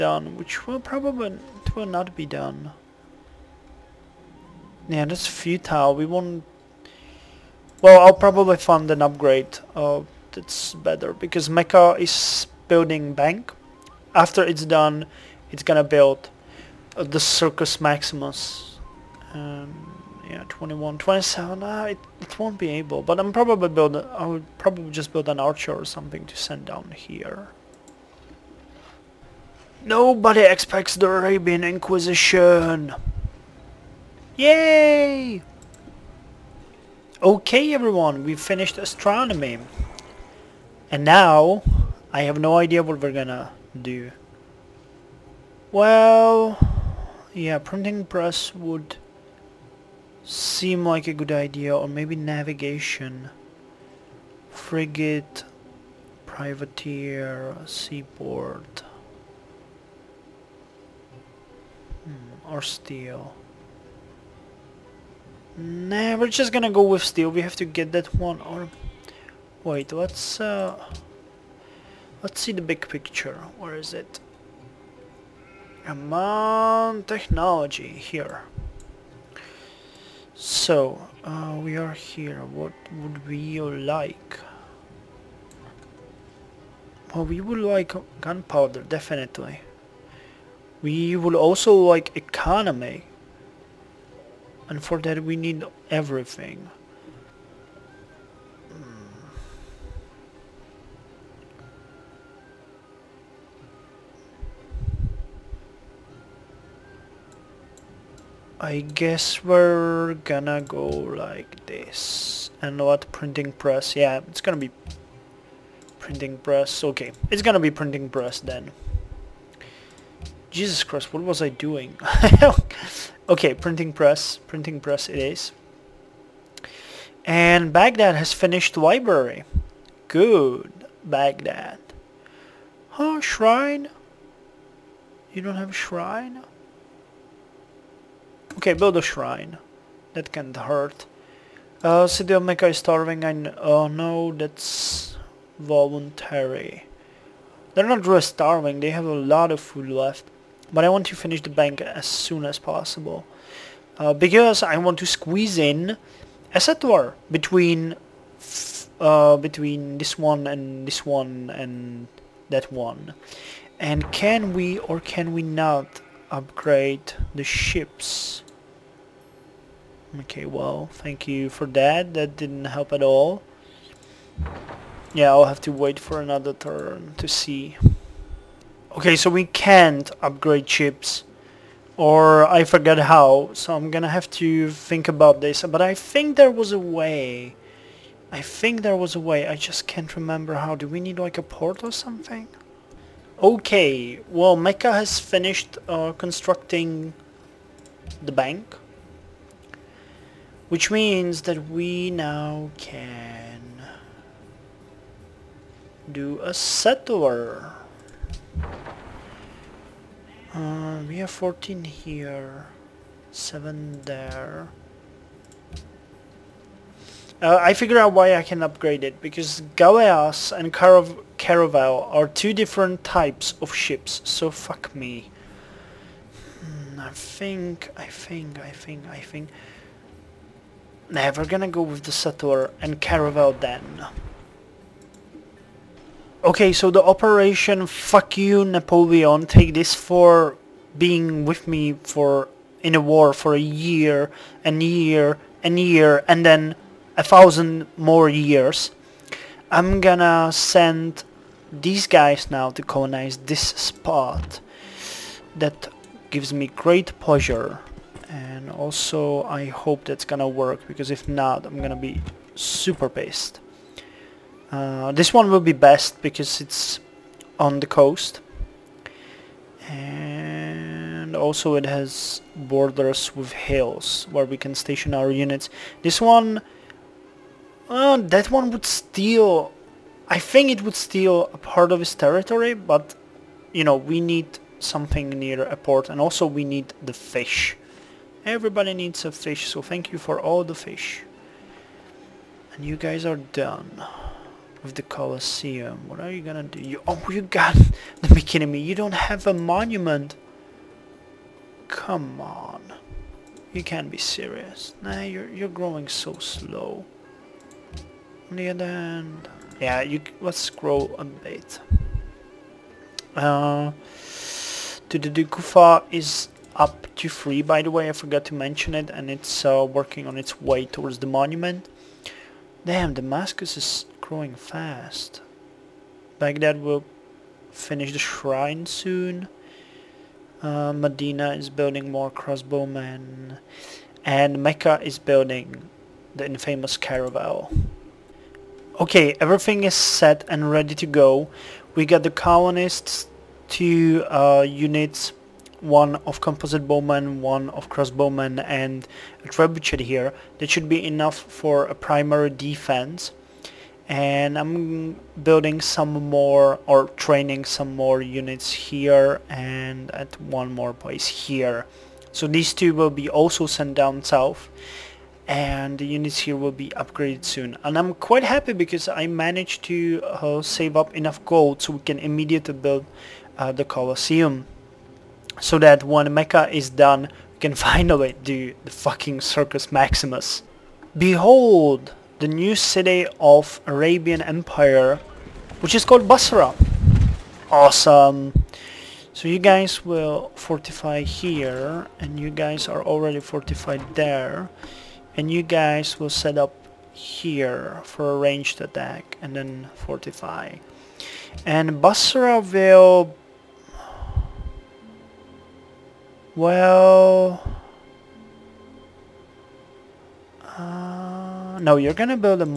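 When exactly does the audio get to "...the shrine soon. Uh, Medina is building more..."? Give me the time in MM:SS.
05:28.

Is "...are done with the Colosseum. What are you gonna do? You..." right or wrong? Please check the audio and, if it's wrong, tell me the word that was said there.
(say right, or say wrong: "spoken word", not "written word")
right.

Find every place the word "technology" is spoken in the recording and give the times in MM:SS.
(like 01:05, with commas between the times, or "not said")
01:17.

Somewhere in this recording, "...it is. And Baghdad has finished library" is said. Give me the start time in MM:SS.
02:05.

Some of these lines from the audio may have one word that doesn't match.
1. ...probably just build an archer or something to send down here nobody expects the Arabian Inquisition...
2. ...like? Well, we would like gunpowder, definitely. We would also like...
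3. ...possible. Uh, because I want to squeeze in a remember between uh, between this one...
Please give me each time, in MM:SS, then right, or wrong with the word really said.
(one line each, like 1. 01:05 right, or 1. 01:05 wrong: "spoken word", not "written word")
1. 00:24 right
2. 01:23 right
3. 02:32 wrong: "settler", not "remember".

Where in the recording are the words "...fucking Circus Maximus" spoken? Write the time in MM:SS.
06:18.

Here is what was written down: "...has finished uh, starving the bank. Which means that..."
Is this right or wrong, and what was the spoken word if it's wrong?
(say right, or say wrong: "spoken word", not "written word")
wrong: "constructing", not "starving".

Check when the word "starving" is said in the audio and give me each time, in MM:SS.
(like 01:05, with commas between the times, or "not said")
02:22, 02:28.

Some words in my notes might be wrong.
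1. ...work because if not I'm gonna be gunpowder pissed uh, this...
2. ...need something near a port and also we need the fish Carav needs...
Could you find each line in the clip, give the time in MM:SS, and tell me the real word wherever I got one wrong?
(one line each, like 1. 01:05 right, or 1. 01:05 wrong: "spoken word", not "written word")
1. 04:20 wrong: "super", not "gunpowder"
2. 04:44 wrong: "Everybody", not "Carav".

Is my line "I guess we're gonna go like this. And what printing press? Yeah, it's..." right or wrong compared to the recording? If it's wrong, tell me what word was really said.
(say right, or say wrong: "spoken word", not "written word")
right.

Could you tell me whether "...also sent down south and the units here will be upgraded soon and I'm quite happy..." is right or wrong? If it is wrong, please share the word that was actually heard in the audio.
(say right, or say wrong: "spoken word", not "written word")
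right.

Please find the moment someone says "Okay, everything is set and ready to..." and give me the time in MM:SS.
05:39.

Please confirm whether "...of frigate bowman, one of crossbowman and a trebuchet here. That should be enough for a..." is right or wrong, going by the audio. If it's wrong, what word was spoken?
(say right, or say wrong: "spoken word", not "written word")
wrong: "composite", not "frigate".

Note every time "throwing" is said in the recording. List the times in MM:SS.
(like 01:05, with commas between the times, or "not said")
not said.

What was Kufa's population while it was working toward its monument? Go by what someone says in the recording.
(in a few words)
3.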